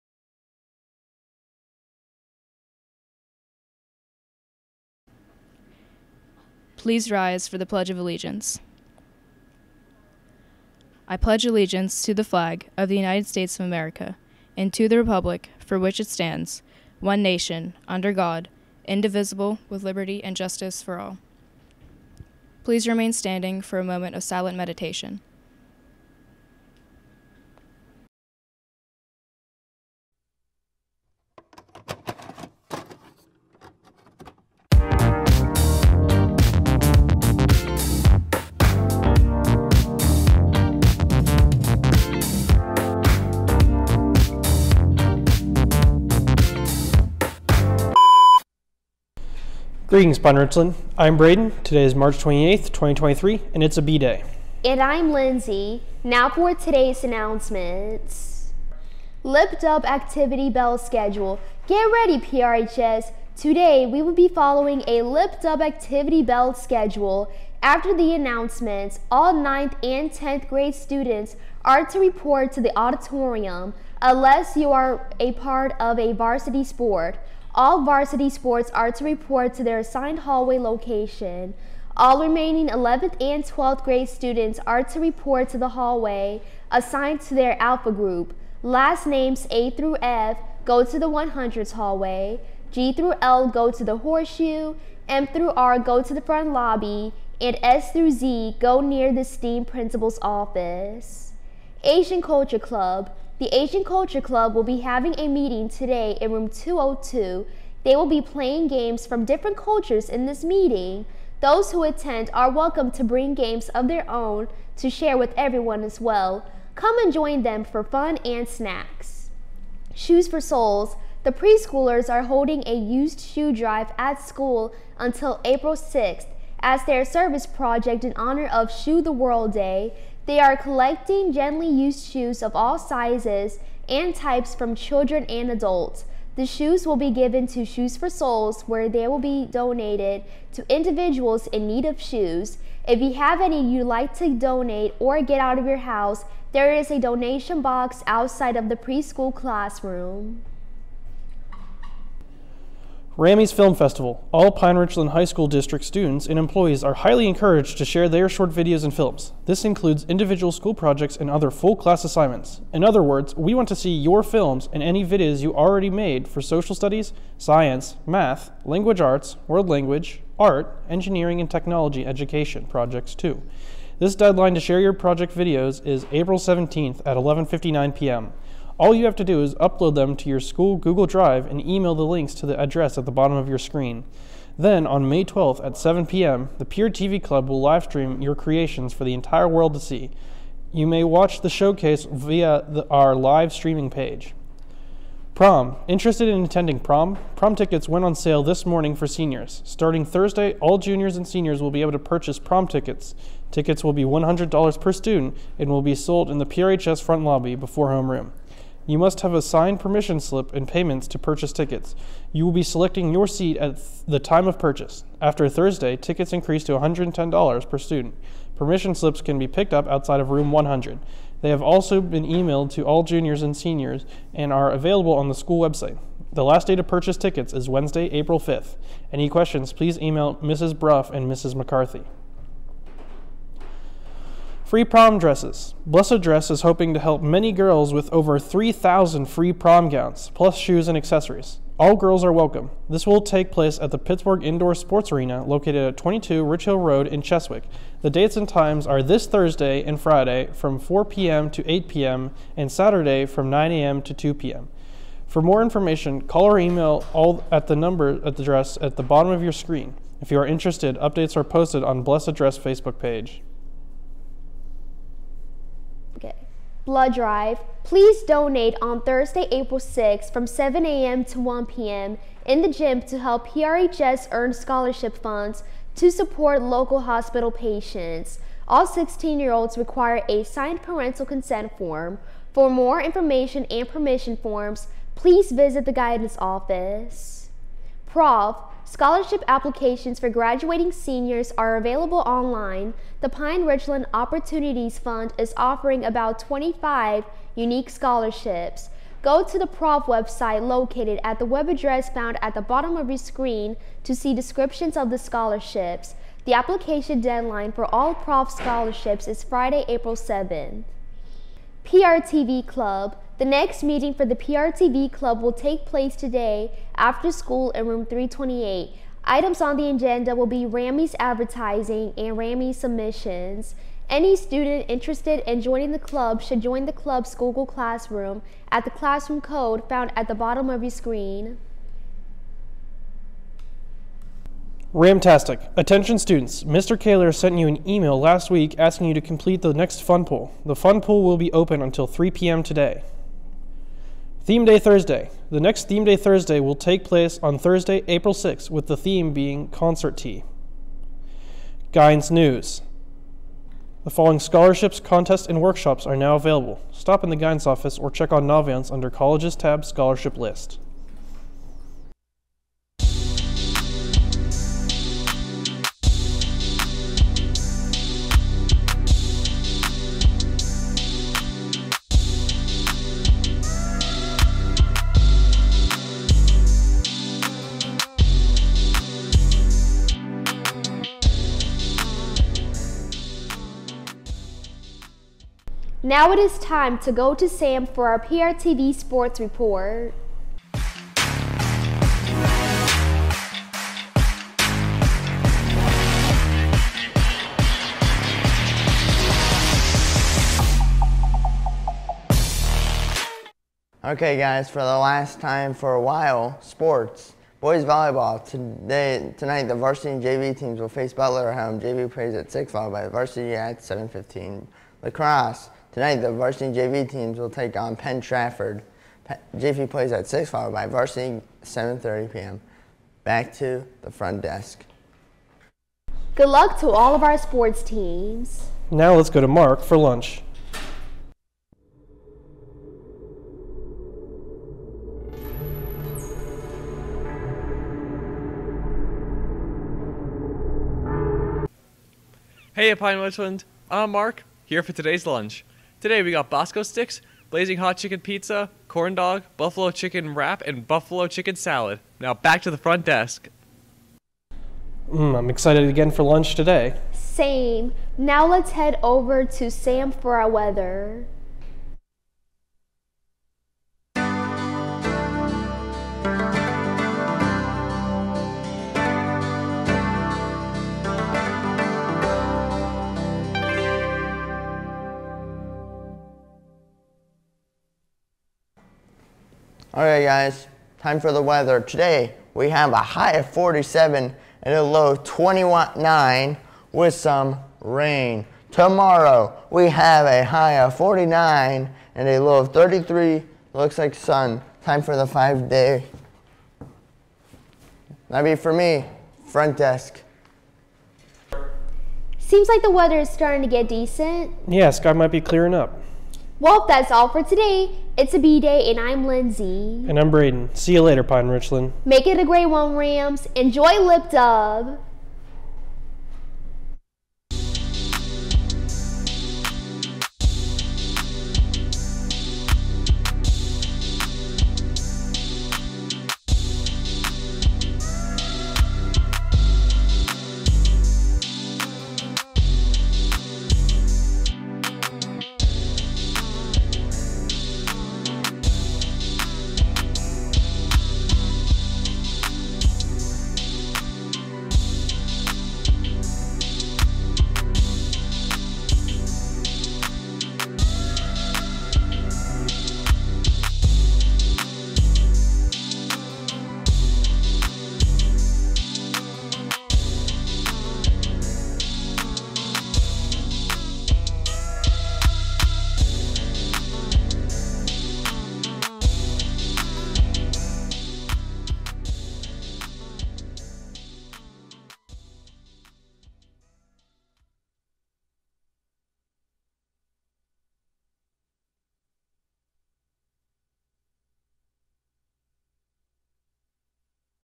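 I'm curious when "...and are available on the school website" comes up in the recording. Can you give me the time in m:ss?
3:44.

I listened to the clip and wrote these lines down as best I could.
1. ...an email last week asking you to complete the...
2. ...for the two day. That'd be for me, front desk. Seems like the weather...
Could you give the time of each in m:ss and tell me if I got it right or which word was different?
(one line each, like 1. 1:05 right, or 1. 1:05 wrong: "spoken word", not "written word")
1. 5:37 right
2. 8:15 wrong: "five", not "two".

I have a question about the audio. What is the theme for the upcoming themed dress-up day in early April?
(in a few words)
Concert Tee.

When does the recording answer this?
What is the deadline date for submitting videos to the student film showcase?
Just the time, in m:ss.
2:56.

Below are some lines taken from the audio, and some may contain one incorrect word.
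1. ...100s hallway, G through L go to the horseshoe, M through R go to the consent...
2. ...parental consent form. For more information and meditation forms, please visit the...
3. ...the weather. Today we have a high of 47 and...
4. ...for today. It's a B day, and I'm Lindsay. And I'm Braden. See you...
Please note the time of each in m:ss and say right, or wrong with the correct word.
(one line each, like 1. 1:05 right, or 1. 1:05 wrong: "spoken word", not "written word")
1. 1:31 wrong: "front", not "consent"
2. 4:40 wrong: "permission", not "meditation"
3. 8:01 right
4. 8:27 right.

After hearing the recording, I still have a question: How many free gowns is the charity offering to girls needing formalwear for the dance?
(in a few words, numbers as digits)
3,000.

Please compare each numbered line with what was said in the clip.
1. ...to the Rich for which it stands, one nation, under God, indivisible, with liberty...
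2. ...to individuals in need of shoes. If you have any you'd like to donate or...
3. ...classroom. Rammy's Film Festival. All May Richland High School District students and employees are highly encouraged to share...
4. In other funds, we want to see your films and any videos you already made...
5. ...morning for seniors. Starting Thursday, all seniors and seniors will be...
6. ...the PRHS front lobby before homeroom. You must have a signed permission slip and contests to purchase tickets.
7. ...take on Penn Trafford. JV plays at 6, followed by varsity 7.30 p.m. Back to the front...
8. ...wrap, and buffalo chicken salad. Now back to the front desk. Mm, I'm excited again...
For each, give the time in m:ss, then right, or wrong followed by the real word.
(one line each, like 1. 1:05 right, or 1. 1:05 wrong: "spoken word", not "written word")
1. 0:14 wrong: "Republic", not "Rich"
2. 2:20 right
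3. 2:29 wrong: "Pine", not "May"
4. 2:42 wrong: "words", not "funds"
5. 3:18 wrong: "juniors", not "seniors"
6. 3:26 wrong: "payments", not "contests"
7. 6:57 right
8. 7:30 right.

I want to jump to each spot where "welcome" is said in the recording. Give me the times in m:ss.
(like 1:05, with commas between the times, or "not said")
1:52, 4:02.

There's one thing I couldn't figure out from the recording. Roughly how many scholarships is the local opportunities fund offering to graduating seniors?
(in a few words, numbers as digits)
25.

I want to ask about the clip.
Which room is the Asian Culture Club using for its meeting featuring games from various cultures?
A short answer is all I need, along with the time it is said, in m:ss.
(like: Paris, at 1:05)
Room 202, at 1:46.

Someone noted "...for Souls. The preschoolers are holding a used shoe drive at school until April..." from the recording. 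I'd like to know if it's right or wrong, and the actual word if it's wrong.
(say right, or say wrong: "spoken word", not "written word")
right.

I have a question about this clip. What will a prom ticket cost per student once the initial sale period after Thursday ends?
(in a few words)
$110.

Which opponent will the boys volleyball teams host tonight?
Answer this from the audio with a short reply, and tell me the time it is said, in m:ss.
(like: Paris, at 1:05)
Butler, at 6:51.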